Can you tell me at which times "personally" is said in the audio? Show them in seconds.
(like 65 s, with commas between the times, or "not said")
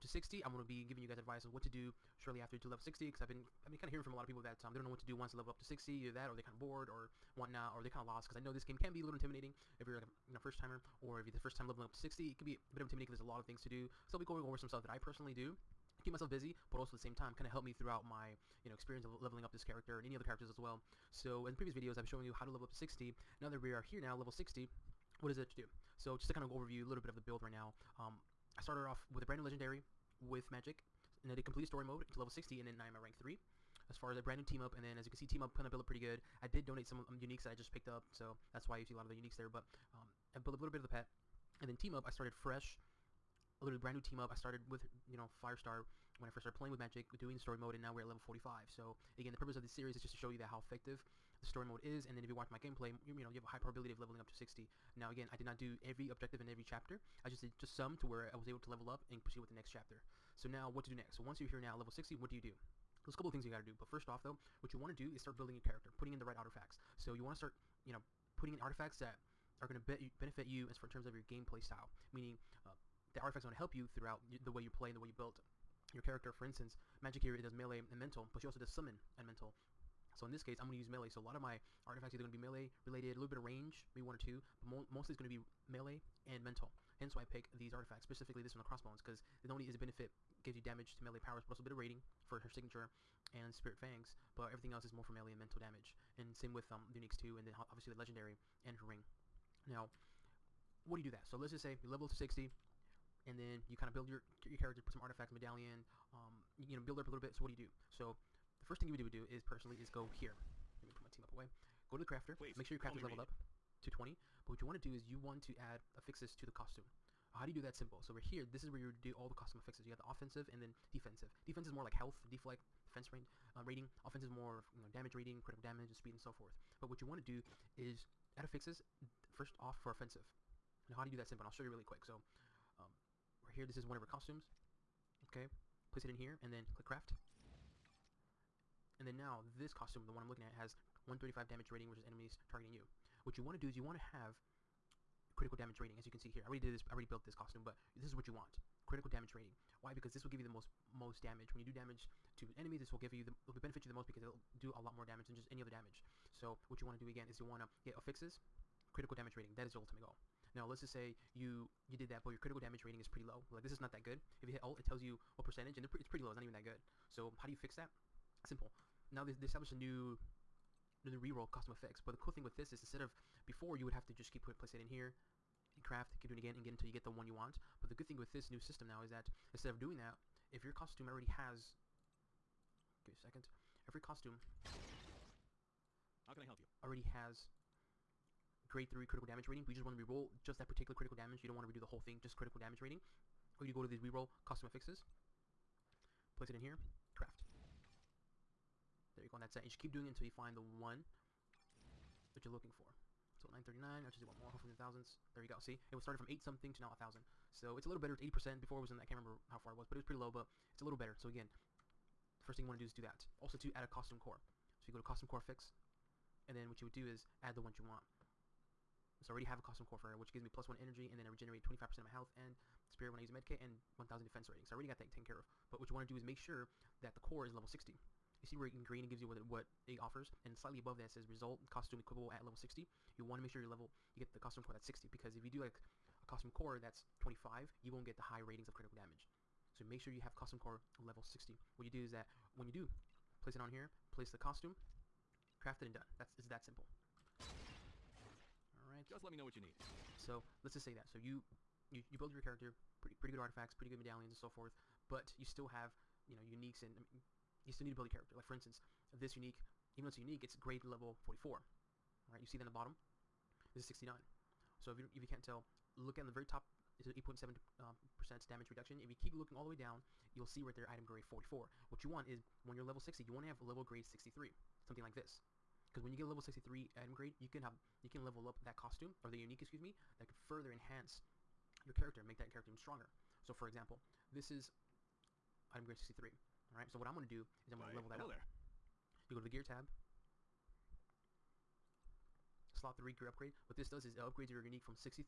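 14 s, 109 s.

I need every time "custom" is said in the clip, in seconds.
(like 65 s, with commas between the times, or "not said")
119 s, 171 s, 194 s, 240 s.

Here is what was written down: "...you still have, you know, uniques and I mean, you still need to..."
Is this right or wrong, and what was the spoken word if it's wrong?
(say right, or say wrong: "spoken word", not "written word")
right.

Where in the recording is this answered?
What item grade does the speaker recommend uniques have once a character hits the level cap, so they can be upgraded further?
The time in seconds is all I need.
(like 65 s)
273 s.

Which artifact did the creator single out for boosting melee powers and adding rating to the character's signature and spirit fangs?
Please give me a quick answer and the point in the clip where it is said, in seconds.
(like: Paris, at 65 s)
Crossbones, at 88 s.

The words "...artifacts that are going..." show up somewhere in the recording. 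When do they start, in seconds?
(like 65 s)
68 s.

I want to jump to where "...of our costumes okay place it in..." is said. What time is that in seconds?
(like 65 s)
133 s.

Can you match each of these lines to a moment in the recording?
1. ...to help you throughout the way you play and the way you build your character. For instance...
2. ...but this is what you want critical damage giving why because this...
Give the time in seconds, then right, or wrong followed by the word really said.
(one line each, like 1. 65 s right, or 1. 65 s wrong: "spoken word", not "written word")
1. 73 s right
2. 147 s wrong: "rating", not "giving".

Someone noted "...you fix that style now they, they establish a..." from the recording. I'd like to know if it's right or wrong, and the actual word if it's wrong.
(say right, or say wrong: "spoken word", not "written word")
wrong: "simple", not "style".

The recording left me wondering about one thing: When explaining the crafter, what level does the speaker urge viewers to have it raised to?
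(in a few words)
20.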